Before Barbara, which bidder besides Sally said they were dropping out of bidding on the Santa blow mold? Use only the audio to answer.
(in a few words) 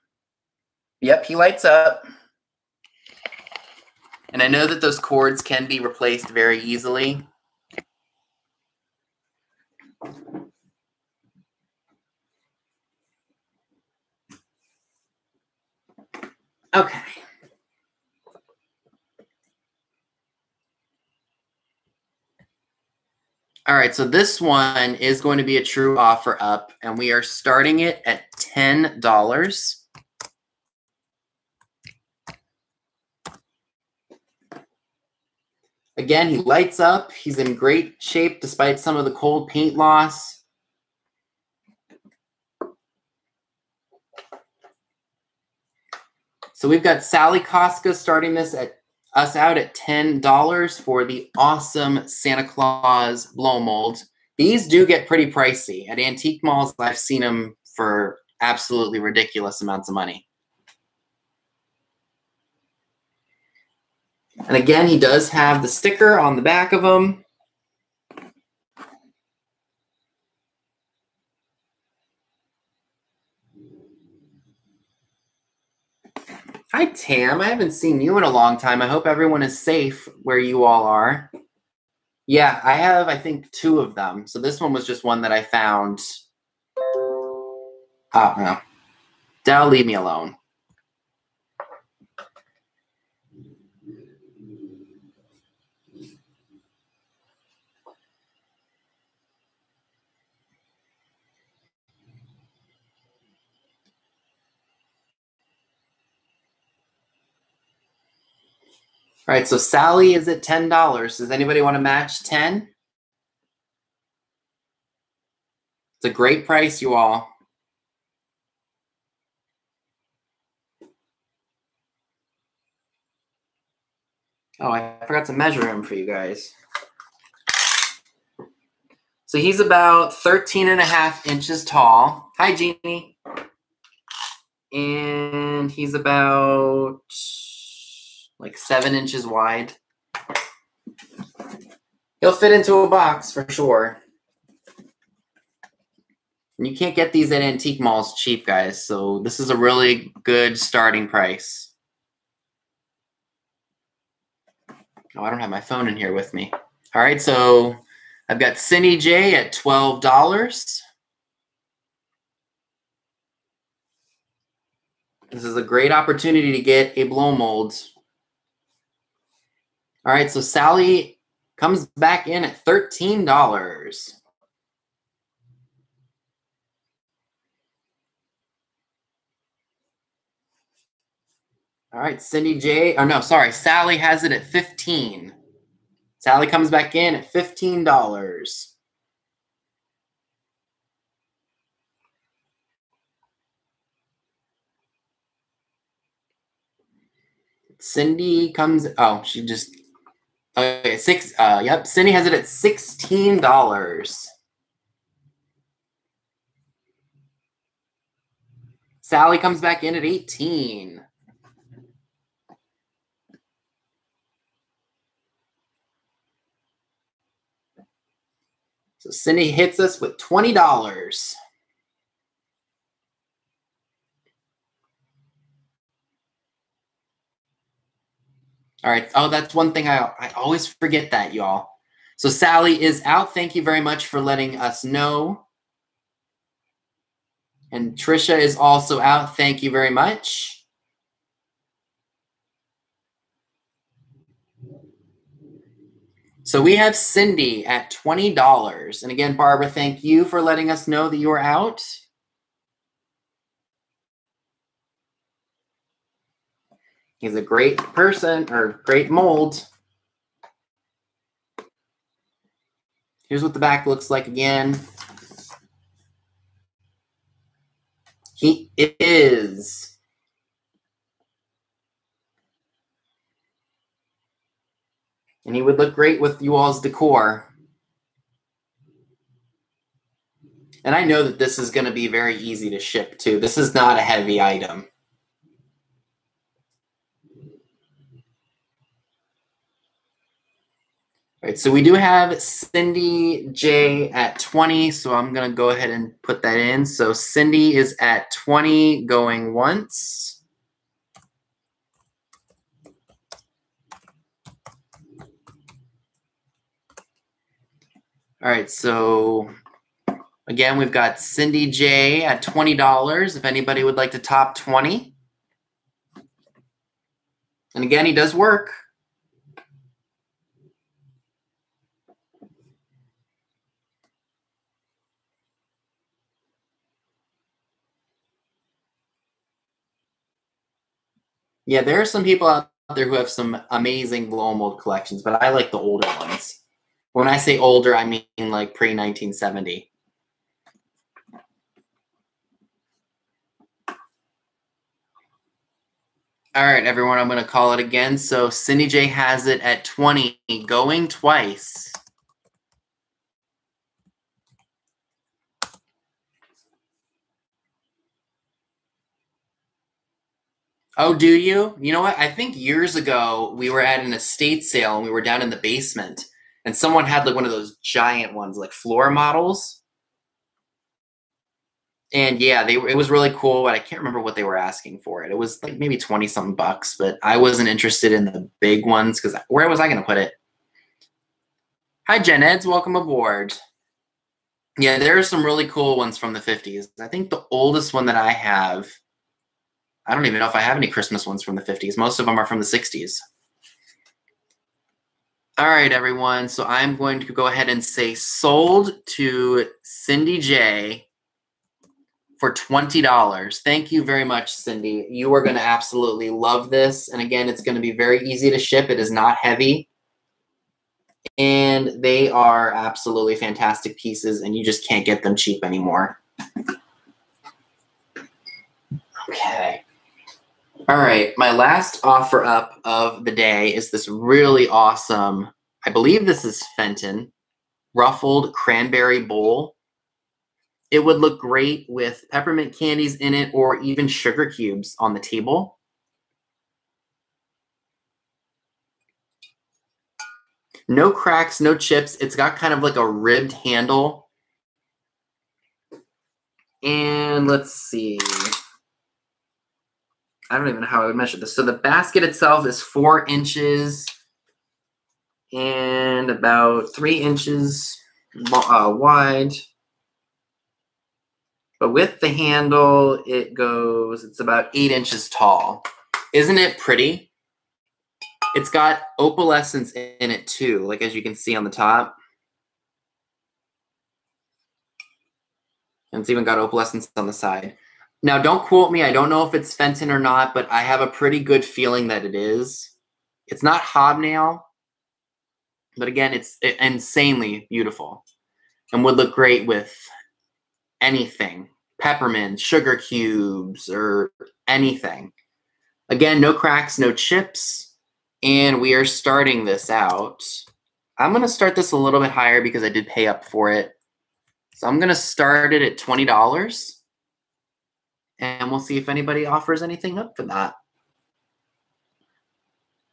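Trisha.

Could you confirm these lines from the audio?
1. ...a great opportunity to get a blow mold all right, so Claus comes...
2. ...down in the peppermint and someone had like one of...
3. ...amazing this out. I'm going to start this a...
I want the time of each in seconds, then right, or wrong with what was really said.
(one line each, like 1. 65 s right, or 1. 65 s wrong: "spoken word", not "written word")
1. 165 s wrong: "Sally", not "Claus"
2. 365 s wrong: "basement", not "peppermint"
3. 499 s wrong: "starting", not "amazing".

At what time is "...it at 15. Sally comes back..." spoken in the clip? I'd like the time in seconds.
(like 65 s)
184 s.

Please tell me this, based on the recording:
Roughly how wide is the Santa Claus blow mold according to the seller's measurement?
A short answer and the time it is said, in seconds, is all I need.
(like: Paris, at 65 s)
7 inches, at 138 s.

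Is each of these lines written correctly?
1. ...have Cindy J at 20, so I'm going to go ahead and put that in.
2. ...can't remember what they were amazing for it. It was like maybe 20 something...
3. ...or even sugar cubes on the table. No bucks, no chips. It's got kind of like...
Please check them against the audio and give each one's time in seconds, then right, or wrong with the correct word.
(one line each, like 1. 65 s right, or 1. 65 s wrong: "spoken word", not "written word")
1. 291 s right
2. 373 s wrong: "asking", not "amazing"
3. 433 s wrong: "cracks", not "bucks".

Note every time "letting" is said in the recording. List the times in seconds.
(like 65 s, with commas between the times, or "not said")
234 s, 250 s.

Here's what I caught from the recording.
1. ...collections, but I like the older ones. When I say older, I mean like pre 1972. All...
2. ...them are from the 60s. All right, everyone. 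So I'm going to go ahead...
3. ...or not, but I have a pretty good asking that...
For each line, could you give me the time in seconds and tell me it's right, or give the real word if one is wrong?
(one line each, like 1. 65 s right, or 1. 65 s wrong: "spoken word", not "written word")
1. 334 s wrong: "1970", not "1972"
2. 392 s right
3. 480 s wrong: "feeling", not "asking".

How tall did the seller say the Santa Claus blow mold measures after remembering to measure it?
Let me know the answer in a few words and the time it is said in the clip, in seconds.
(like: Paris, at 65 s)
13.5 inches, at 130 s.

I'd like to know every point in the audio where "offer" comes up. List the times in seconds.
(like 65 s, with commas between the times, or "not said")
25 s, 422 s, 509 s.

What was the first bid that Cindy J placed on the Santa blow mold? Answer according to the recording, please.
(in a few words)
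$12.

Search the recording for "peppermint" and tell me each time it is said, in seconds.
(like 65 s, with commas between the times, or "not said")
432 s, 491 s.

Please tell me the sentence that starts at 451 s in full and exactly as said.
So the basket itself is four inches and about three inches uh, wide.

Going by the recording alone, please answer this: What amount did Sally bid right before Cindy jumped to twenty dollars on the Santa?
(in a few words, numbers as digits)
$18.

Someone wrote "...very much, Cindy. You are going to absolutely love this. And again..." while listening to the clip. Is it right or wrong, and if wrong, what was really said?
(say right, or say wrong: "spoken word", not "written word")
right.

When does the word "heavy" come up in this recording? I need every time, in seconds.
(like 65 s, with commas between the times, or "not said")
284 s, 409 s.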